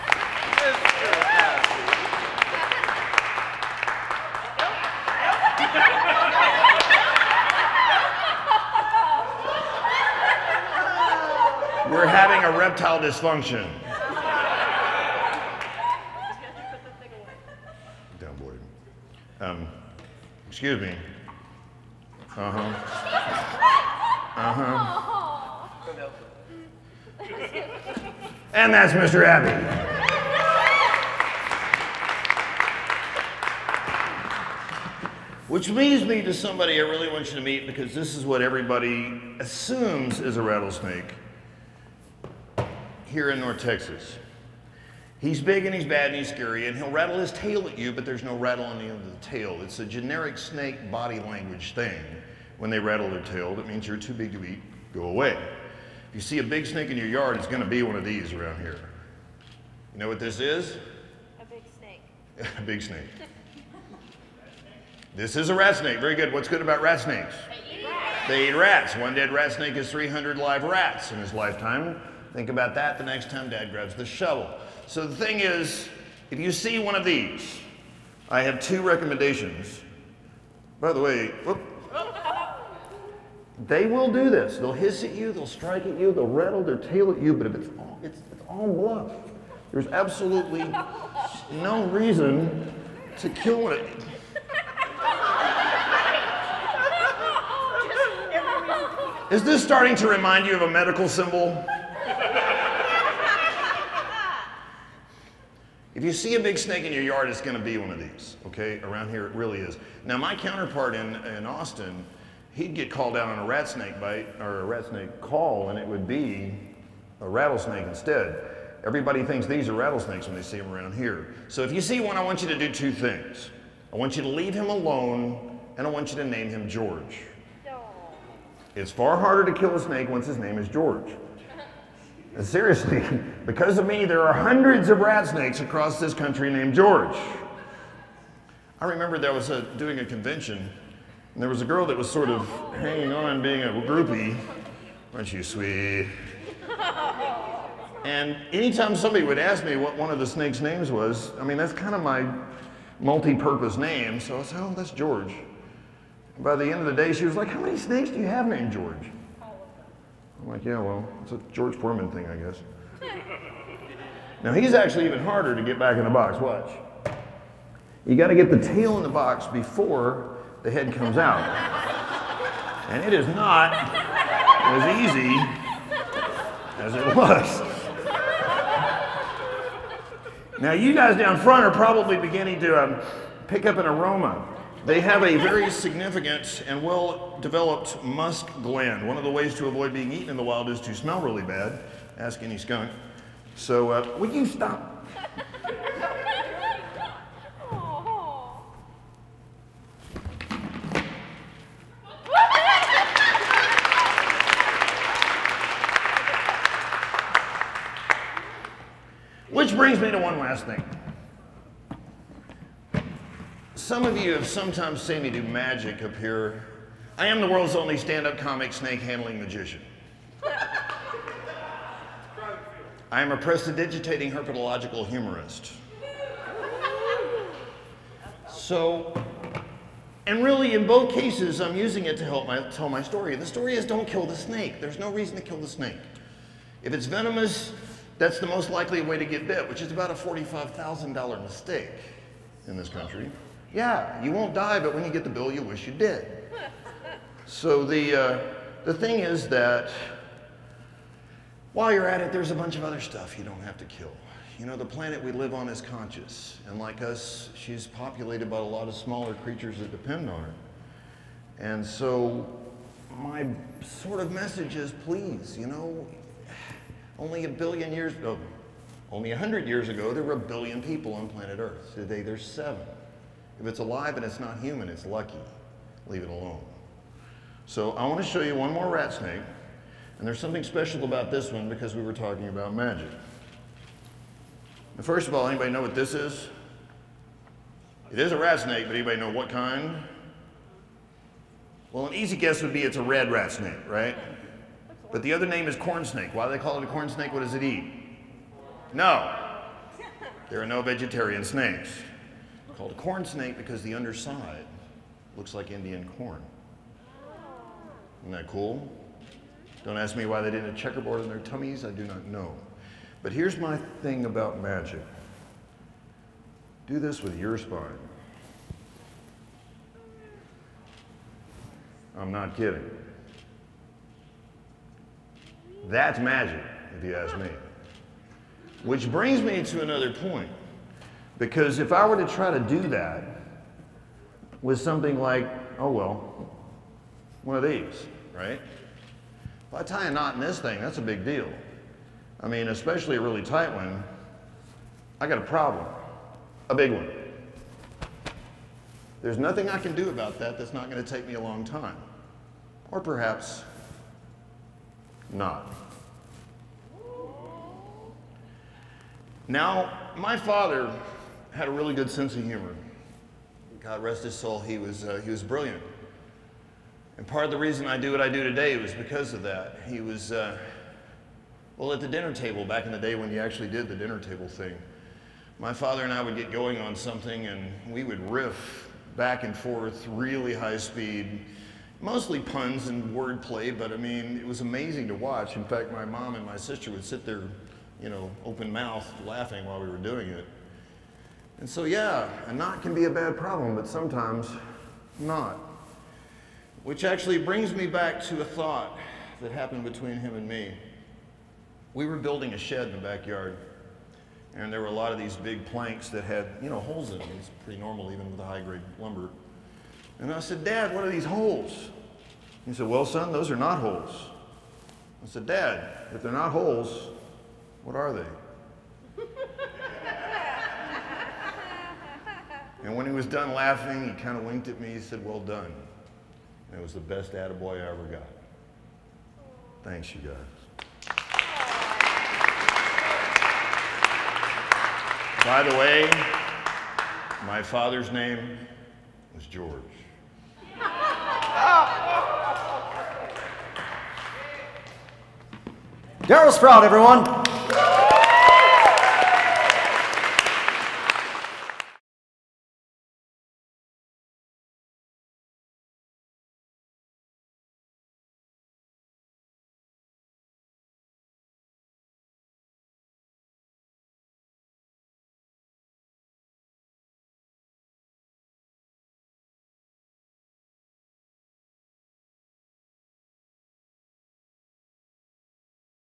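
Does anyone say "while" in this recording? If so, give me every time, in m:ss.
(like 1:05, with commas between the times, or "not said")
4:11, 6:29.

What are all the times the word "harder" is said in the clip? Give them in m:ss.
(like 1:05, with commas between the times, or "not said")
2:09, 2:45.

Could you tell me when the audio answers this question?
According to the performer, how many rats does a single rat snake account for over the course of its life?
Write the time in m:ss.
1:09.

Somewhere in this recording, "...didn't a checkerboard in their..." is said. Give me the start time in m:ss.
5:10.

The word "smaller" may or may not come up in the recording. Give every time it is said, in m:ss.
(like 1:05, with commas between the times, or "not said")
4:18.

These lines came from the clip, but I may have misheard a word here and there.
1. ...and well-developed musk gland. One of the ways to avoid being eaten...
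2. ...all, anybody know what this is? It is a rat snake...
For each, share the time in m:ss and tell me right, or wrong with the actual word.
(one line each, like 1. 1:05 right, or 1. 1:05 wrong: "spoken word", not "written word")
1. 3:06 right
2. 4:45 right.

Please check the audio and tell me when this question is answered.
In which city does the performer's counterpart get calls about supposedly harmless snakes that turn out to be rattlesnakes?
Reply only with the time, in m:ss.
1:51.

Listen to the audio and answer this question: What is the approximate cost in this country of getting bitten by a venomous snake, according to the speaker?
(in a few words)
$45,000.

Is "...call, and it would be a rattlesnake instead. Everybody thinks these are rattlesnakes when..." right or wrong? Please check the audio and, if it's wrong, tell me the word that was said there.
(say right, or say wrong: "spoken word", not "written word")
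right.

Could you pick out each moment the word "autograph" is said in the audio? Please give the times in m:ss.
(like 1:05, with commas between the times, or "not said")
not said.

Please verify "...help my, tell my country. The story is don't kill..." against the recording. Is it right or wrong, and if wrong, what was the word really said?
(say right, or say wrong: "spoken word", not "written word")
wrong: "story", not "country".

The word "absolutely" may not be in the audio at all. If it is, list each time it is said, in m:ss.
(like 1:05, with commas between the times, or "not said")
1:29.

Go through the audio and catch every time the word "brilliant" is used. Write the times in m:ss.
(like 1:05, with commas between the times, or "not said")
6:05.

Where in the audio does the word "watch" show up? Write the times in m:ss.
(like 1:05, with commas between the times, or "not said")
2:46, 6:25.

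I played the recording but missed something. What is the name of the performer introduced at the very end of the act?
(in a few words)
Daryl Sprout.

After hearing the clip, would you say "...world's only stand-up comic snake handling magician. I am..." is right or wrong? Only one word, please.
right.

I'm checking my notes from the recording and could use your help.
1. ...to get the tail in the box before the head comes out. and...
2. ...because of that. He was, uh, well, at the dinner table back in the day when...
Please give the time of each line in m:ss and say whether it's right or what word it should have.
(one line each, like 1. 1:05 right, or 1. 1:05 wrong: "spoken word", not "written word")
1. 2:48 right
2. 6:08 right.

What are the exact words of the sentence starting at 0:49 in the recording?
It's a generic snake body language thing.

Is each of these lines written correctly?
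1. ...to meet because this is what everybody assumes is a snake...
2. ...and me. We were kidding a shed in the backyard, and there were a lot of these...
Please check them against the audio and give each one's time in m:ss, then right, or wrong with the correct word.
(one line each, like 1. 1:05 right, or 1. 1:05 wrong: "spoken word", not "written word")
1. 0:37 wrong: "rattlesnake", not "snake"
2. 6:40 wrong: "building", not "kidding".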